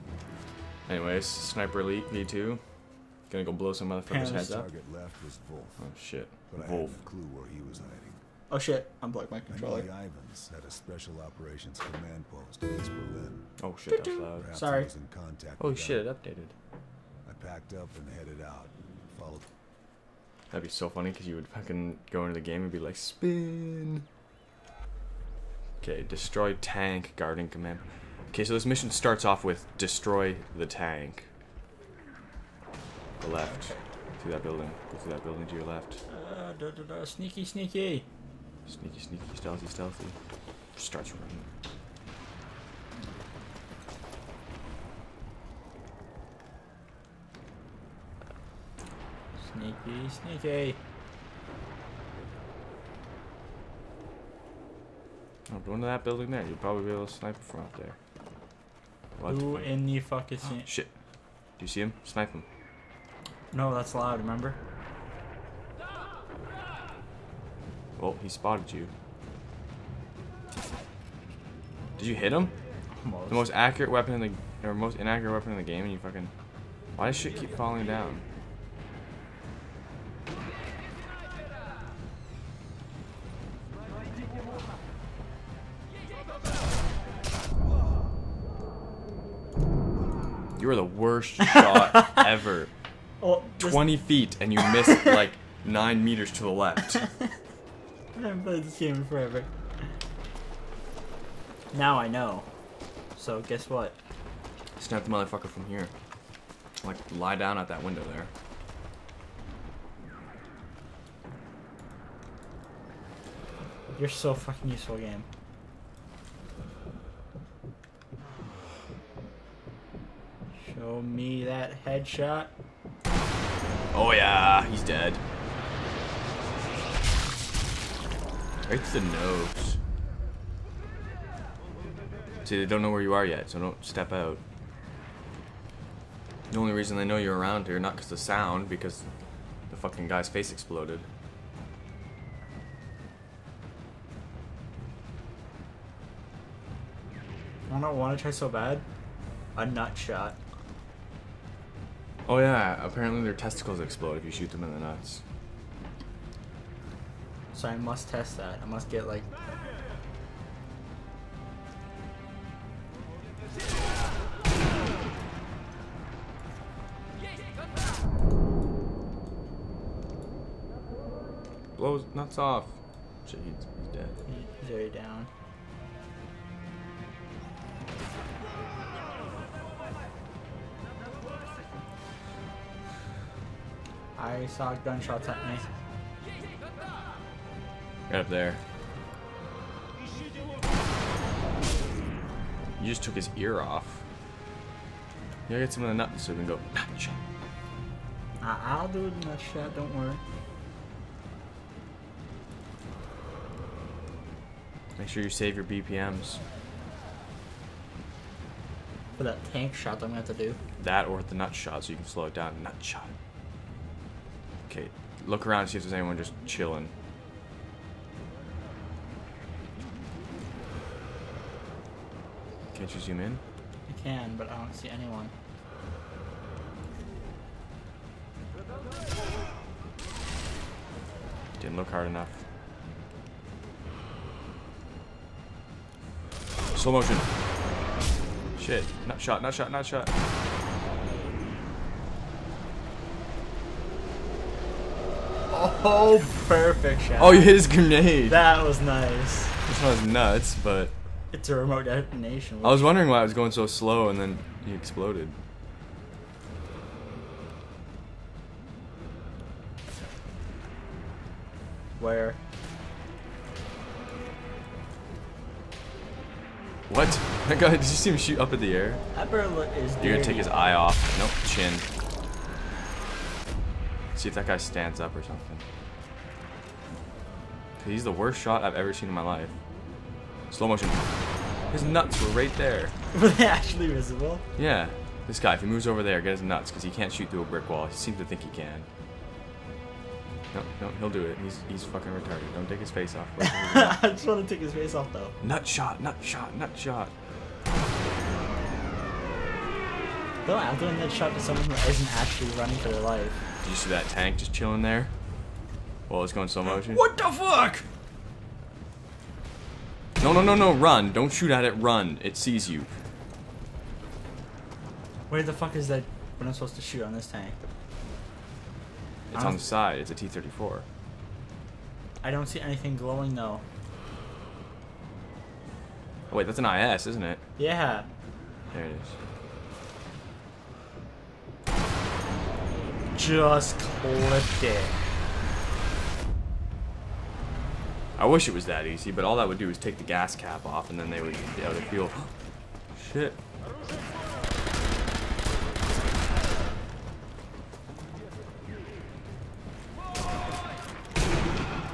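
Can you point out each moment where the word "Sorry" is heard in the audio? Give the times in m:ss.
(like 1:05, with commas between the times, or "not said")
0:14.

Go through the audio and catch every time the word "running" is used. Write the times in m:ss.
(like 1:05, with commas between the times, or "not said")
0:41, 5:02.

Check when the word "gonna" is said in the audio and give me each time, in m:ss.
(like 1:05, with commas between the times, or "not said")
0:03, 3:30, 4:30.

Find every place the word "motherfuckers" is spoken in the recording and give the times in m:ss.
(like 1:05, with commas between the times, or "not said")
0:03, 1:45.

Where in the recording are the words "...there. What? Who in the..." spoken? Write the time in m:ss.
0:57.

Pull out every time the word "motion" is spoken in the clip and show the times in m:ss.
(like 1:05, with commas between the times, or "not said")
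3:56, 4:40, 5:06.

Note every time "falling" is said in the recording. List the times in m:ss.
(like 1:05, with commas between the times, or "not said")
1:17.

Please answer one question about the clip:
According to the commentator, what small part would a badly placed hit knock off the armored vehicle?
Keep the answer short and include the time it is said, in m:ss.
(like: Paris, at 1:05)
gas cap, at 5:40.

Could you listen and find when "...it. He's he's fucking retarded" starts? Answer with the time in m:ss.
4:51.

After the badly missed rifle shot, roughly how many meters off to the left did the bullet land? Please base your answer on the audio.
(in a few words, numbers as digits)
9.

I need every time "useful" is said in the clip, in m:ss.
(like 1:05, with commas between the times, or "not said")
1:54.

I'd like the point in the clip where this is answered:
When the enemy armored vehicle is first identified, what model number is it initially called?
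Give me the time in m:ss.
5:20.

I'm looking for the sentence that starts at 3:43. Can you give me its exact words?
I can, but I don't see anyone.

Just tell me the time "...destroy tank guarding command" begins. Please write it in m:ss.
0:26.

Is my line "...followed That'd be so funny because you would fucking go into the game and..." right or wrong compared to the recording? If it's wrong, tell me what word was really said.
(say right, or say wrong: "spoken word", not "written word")
right.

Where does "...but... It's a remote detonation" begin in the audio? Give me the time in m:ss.
4:10.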